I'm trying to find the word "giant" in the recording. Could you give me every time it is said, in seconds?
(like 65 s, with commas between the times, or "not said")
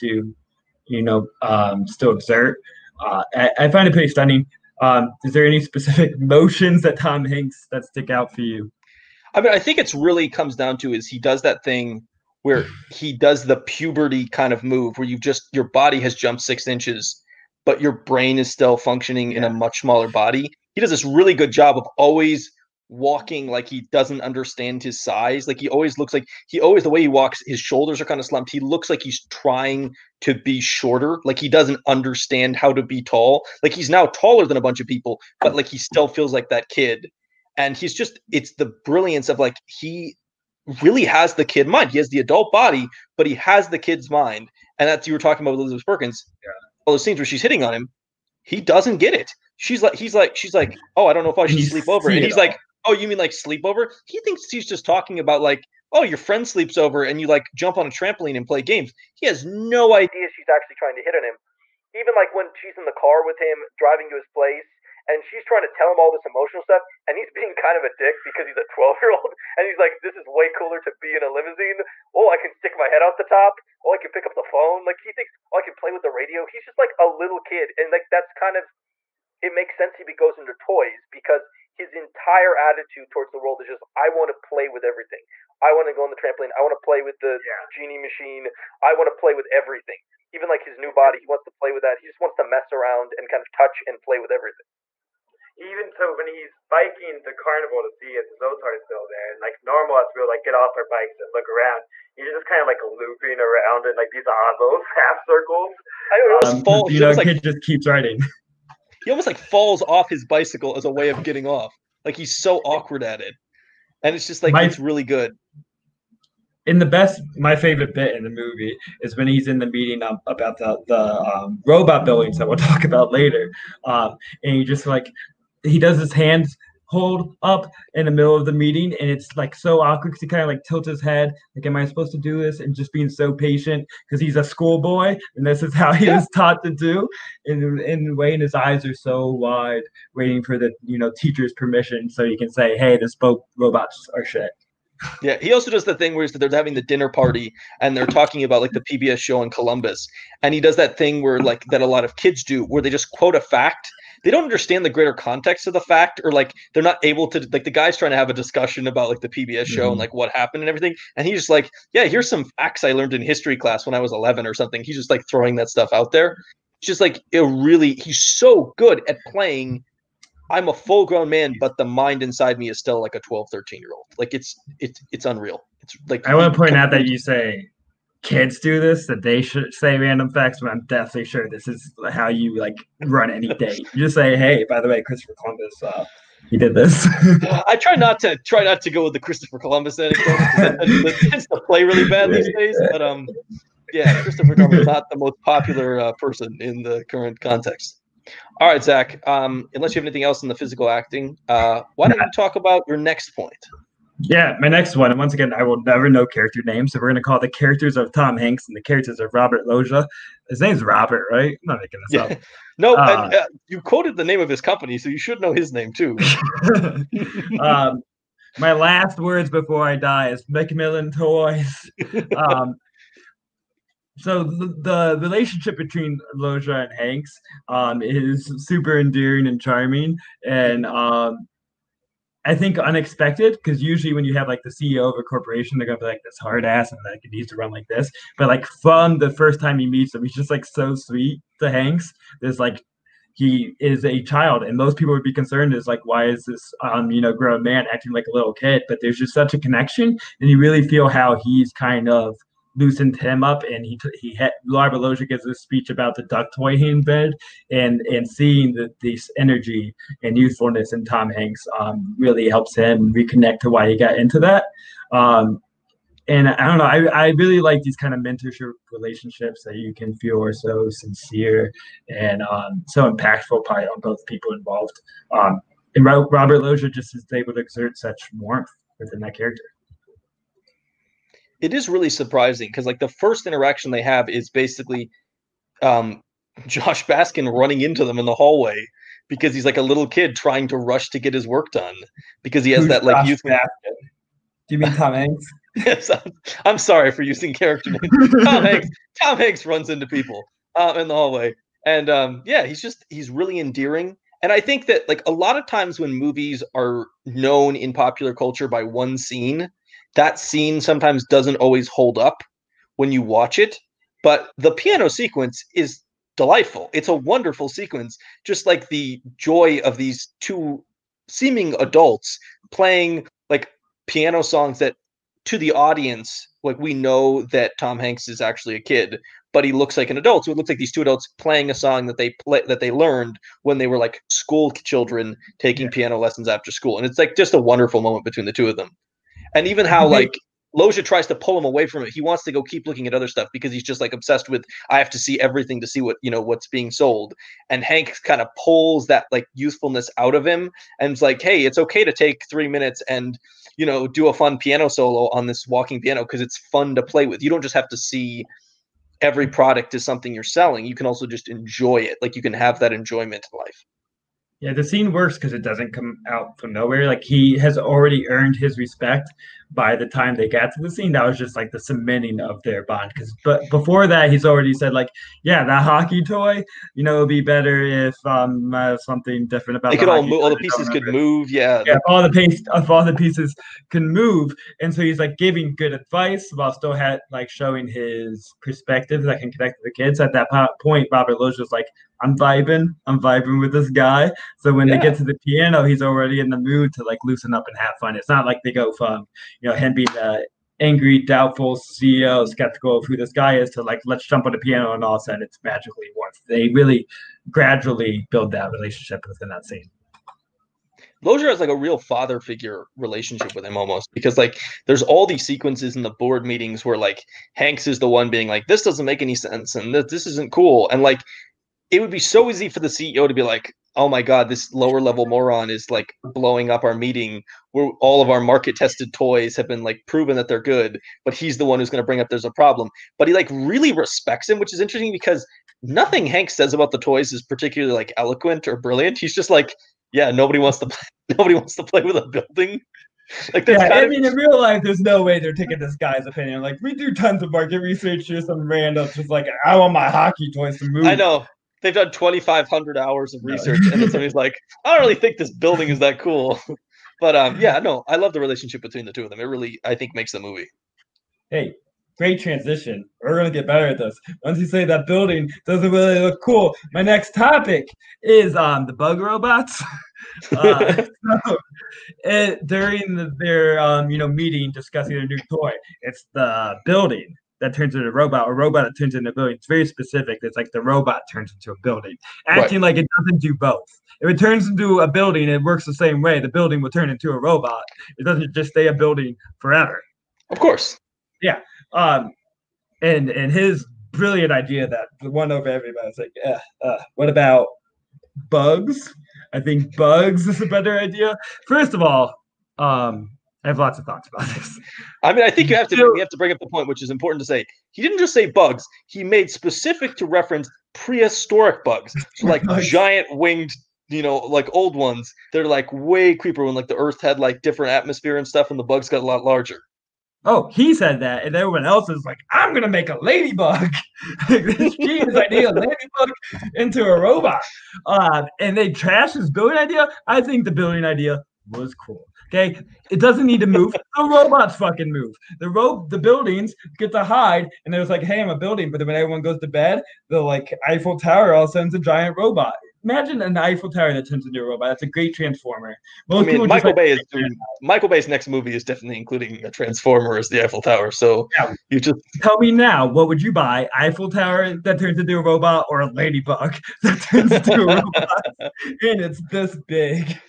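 512 s, 541 s.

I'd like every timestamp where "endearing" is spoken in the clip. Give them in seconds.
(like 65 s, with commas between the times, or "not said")
229 s, 303 s.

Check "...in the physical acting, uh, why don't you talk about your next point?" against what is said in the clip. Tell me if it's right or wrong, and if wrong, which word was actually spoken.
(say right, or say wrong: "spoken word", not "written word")
right.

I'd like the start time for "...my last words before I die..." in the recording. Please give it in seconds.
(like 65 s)
218 s.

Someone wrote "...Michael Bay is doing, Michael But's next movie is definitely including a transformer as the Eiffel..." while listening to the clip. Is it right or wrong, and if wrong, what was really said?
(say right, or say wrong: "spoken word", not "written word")
wrong: "Bay", not "But".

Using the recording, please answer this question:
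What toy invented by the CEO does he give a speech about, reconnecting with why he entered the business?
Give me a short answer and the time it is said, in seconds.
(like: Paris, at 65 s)
duck toy, at 256 s.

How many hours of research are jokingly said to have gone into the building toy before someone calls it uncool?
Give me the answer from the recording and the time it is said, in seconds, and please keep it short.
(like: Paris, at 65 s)
2,500, at 452 s.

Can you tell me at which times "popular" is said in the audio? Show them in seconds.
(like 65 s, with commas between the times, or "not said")
195 s, 307 s.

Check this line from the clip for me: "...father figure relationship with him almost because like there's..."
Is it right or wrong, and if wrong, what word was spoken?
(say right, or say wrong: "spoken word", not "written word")
right.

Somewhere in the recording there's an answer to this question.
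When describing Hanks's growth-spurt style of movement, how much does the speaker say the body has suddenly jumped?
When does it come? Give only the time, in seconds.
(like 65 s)
16 s.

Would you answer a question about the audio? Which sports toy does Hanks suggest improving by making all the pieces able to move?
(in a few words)
hockey toy.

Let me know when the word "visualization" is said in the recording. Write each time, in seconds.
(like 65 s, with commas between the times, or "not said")
not said.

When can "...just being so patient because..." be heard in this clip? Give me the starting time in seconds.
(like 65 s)
132 s.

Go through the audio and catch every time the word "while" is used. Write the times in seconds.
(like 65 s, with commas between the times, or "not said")
386 s.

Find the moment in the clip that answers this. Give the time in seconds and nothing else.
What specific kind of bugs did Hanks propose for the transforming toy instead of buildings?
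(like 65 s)
510 s.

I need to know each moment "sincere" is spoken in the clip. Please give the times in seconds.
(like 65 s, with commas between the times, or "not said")
270 s.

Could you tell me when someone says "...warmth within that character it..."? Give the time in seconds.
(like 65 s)
278 s.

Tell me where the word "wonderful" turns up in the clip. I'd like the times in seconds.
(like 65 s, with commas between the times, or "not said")
317 s, 337 s.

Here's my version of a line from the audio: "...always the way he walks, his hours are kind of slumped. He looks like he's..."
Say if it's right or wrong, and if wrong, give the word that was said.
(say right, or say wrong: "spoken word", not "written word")
wrong: "shoulders", not "hours".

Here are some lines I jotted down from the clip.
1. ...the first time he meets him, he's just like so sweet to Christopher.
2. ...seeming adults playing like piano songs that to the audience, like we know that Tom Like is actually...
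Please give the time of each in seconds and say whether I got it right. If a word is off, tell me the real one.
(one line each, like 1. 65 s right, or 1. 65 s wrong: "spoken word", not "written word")
1. 239 s wrong: "Hanks", not "Christopher"
2. 321 s wrong: "Hanks", not "Like".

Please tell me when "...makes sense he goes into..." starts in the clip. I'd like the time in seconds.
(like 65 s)
79 s.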